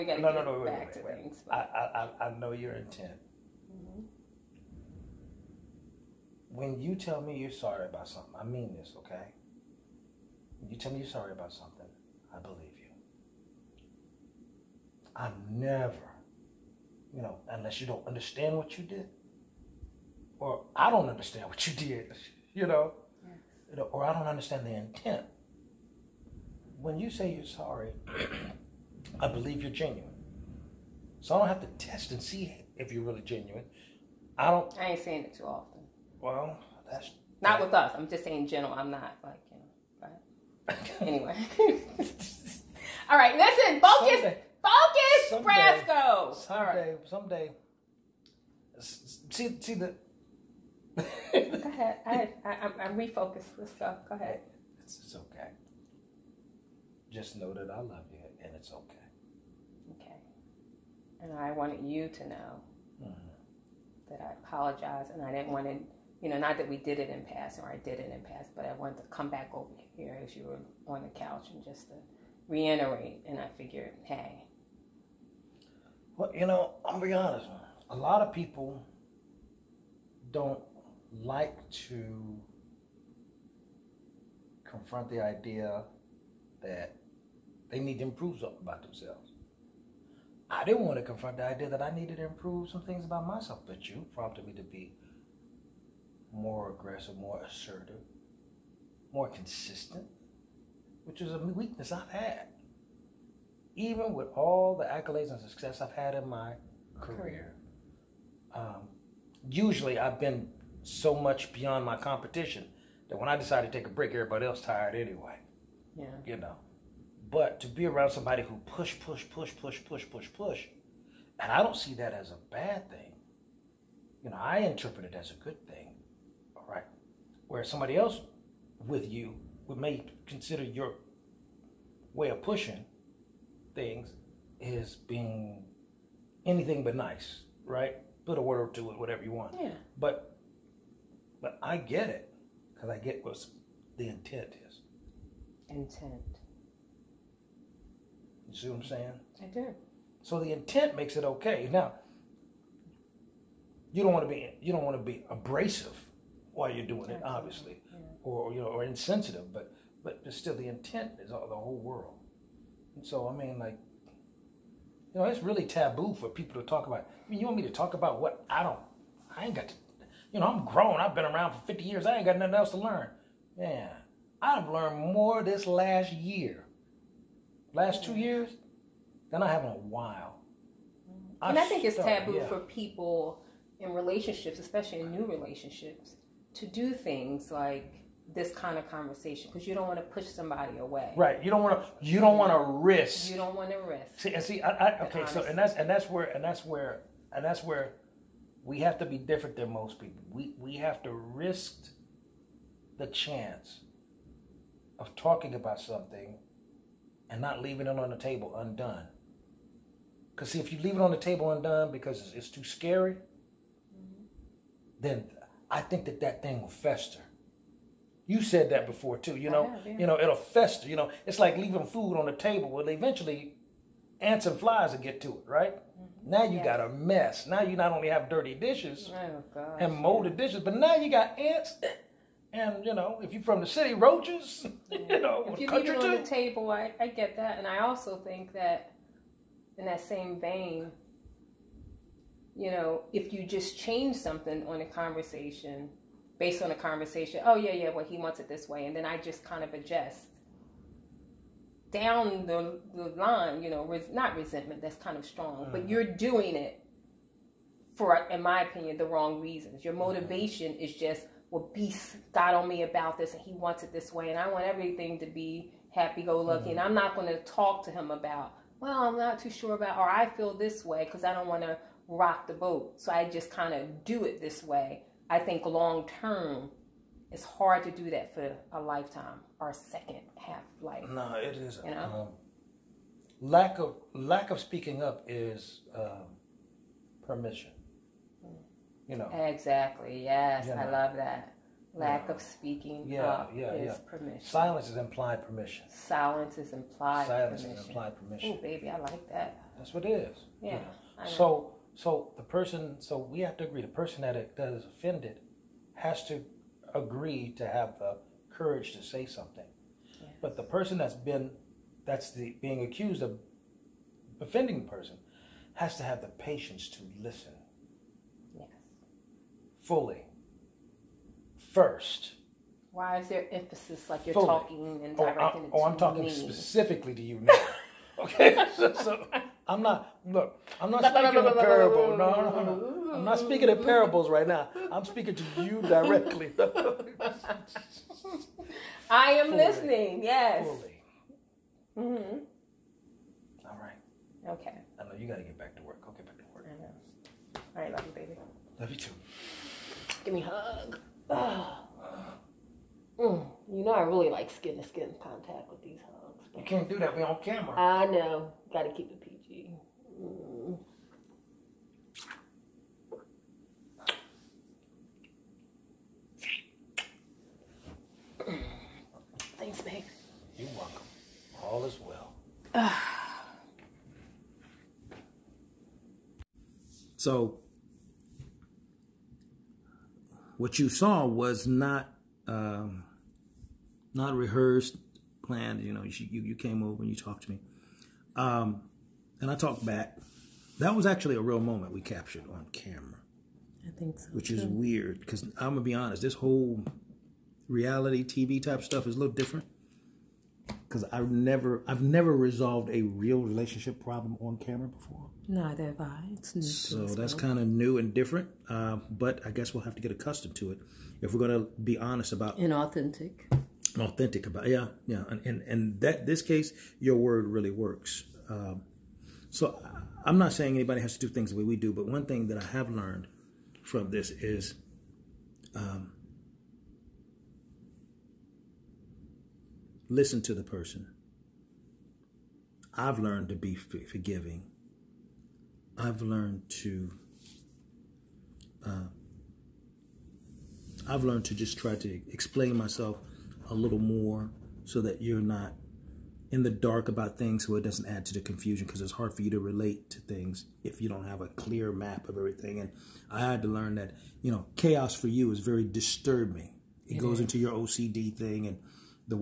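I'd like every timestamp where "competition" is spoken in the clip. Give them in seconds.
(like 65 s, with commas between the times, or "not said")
111 s.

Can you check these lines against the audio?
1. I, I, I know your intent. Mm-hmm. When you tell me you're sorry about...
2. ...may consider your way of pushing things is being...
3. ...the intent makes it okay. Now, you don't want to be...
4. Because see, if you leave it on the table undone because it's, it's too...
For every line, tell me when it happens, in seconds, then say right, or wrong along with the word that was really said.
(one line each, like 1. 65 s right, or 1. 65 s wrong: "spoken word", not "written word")
1. 1 s right
2. 129 s right
3. 150 s right
4. 210 s right.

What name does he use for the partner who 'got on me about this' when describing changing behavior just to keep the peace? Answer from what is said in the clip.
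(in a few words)
Beast.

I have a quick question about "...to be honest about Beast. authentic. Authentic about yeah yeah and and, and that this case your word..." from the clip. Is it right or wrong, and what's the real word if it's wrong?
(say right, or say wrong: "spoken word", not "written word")
wrong: "Inauthentic", not "Beast".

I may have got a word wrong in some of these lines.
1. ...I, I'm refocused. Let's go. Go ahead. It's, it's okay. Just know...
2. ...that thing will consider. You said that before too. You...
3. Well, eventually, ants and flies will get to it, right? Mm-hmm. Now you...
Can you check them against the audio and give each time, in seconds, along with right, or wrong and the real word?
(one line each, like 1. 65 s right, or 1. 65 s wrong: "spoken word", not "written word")
1. 52 s right
2. 216 s wrong: "fester", not "consider"
3. 222 s right.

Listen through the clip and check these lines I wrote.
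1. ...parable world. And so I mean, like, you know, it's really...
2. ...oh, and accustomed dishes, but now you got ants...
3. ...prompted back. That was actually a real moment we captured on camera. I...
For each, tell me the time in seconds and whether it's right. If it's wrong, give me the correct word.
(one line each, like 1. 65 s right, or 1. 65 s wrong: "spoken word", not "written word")
1. 161 s wrong: "whole", not "parable"
2. 229 s wrong: "molded", not "accustomed"
3. 389 s wrong: "talked", not "prompted".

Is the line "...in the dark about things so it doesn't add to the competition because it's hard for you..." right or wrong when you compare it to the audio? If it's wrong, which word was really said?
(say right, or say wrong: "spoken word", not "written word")
wrong: "confusion", not "competition".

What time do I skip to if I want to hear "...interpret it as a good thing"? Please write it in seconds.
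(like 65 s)
124 s.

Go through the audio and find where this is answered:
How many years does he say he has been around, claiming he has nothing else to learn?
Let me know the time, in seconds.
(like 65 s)
171 s.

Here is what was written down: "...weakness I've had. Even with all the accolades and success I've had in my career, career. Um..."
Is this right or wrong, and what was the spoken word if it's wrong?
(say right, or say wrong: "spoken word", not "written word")
right.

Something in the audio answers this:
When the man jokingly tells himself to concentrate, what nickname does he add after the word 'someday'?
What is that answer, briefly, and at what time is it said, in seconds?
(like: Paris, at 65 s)
Brasco, at 45 s.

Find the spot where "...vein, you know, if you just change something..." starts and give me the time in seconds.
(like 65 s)
240 s.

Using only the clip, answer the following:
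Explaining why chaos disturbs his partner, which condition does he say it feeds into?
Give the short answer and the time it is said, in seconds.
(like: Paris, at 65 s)
OCD, at 457 s.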